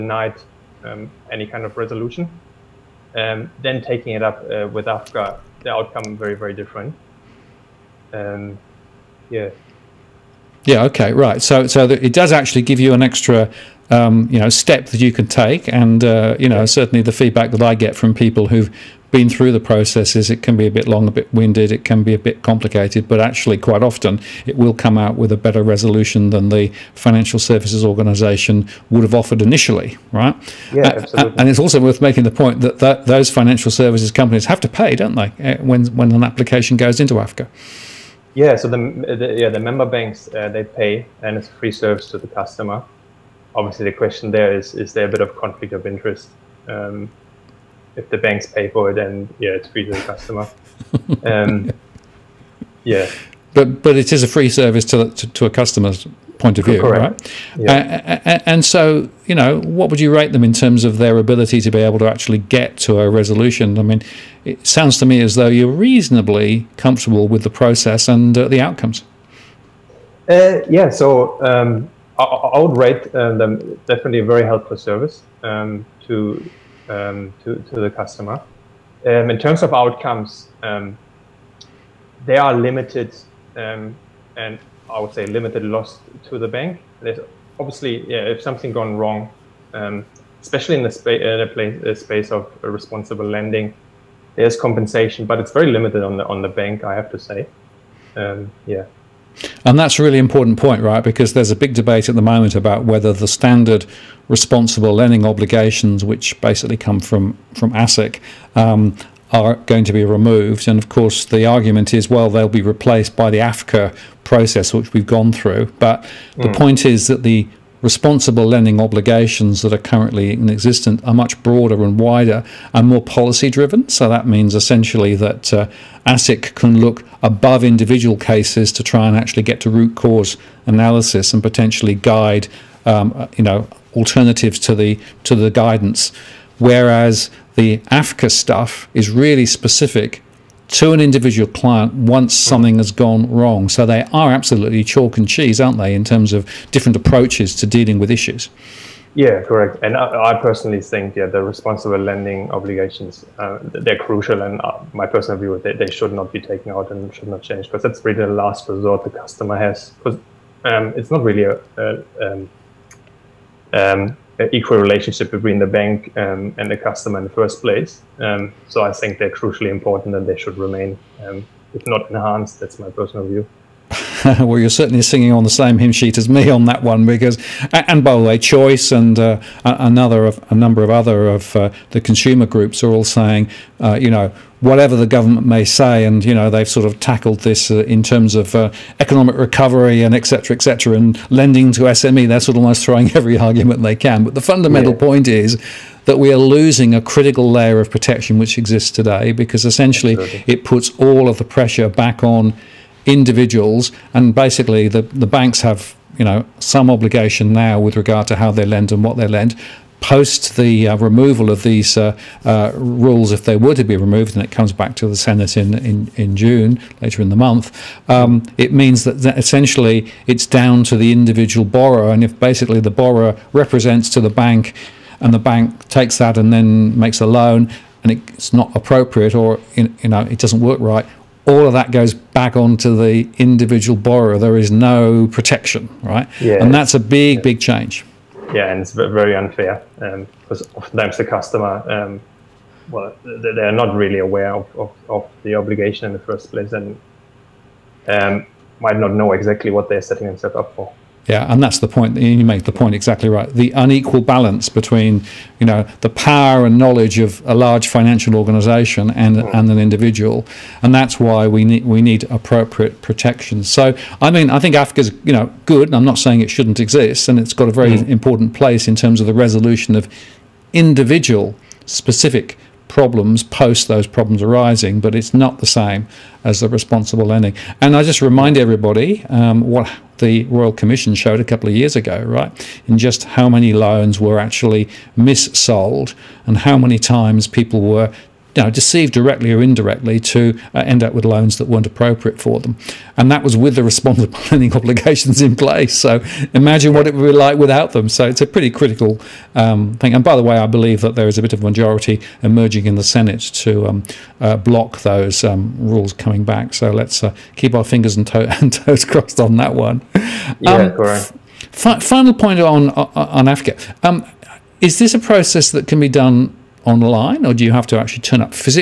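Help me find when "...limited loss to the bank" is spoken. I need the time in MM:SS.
01:25.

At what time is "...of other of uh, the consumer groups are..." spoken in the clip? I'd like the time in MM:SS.
03:00.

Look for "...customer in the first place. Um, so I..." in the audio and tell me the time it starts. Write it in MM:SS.
02:46.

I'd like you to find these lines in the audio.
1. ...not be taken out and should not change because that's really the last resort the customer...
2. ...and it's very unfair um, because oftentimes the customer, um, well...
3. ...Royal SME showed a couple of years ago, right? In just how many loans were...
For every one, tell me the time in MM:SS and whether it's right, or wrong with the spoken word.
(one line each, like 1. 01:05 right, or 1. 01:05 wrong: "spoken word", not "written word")
1. 02:36 right
2. 03:58 right
3. 04:40 wrong: "Commission", not "SME".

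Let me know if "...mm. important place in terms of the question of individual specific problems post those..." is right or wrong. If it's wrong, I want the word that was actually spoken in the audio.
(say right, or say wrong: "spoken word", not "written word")
wrong: "resolution", not "question".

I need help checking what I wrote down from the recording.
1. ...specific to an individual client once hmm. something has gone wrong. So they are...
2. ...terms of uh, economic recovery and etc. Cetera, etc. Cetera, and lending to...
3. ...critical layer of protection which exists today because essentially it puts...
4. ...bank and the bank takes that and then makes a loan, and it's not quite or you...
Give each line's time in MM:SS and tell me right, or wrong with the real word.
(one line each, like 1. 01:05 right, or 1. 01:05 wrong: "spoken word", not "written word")
1. 02:19 right
2. 03:08 right
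3. 03:17 right
4. 03:44 wrong: "appropriate", not "quite".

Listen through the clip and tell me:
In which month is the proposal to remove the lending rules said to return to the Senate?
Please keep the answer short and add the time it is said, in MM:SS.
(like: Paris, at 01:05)
June, at 03:36.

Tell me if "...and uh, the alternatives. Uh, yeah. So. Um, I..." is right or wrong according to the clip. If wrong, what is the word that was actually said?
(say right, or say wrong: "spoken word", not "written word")
wrong: "outcomes", not "alternatives".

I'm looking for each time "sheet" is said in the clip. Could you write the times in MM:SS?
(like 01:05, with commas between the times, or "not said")
02:55.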